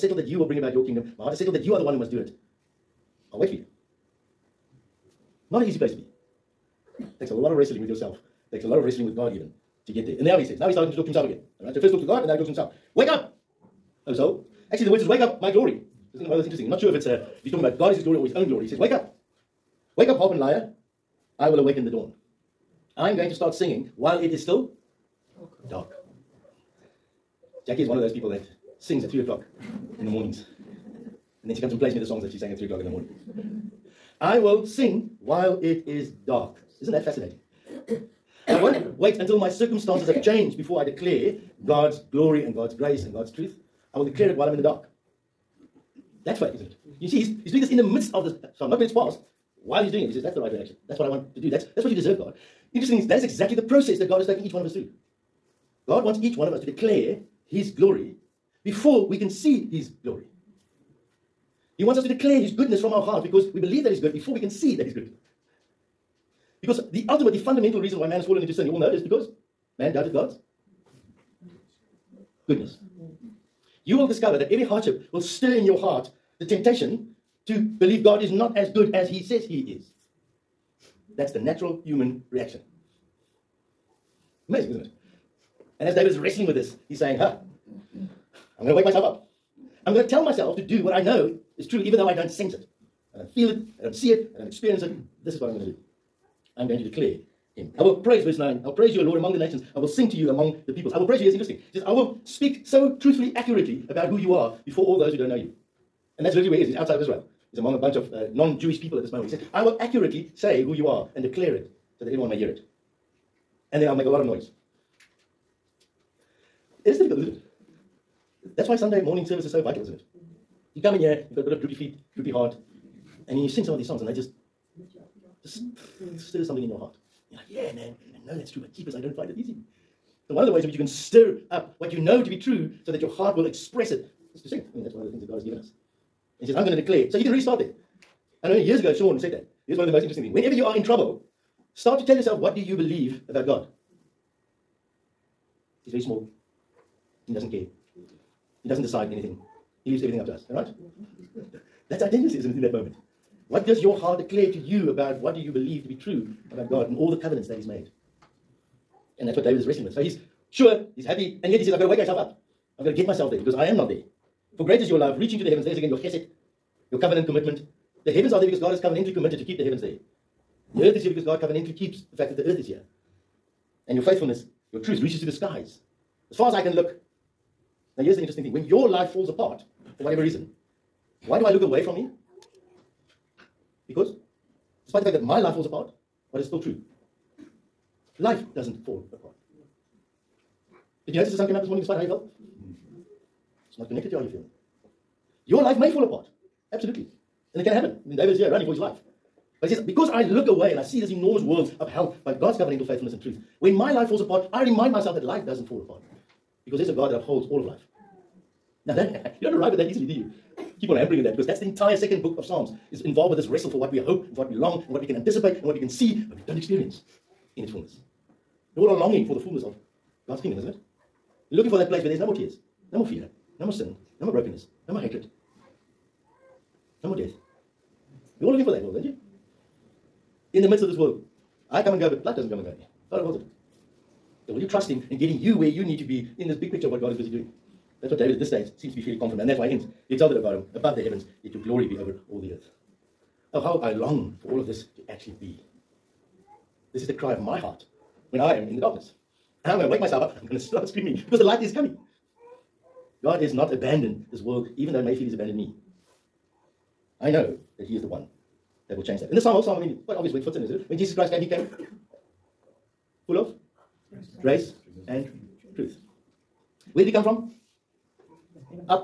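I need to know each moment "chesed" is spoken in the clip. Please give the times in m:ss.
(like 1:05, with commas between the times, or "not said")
2:45.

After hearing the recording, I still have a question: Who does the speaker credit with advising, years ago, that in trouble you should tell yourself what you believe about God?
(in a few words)
Sean.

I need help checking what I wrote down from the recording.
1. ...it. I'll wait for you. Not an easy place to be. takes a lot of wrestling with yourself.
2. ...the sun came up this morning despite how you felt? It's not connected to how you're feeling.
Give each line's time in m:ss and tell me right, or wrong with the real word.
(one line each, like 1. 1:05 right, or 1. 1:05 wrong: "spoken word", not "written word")
1. 0:02 right
2. 3:11 right.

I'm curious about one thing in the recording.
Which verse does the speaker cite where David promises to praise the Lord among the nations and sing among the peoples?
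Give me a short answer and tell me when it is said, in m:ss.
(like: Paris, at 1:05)
Verse 9, at 1:38.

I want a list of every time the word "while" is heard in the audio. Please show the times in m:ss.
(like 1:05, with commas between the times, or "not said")
0:23, 0:35, 0:44, 0:49.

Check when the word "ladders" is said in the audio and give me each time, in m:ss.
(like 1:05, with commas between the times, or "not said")
not said.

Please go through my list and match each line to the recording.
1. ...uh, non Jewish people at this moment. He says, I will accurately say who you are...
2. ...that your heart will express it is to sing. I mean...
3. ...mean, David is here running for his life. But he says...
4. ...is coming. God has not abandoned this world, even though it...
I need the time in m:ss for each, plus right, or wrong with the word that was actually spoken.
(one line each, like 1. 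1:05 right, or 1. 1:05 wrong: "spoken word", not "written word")
1. 1:48 right
2. 2:12 right
3. 3:18 right
4. 4:11 right.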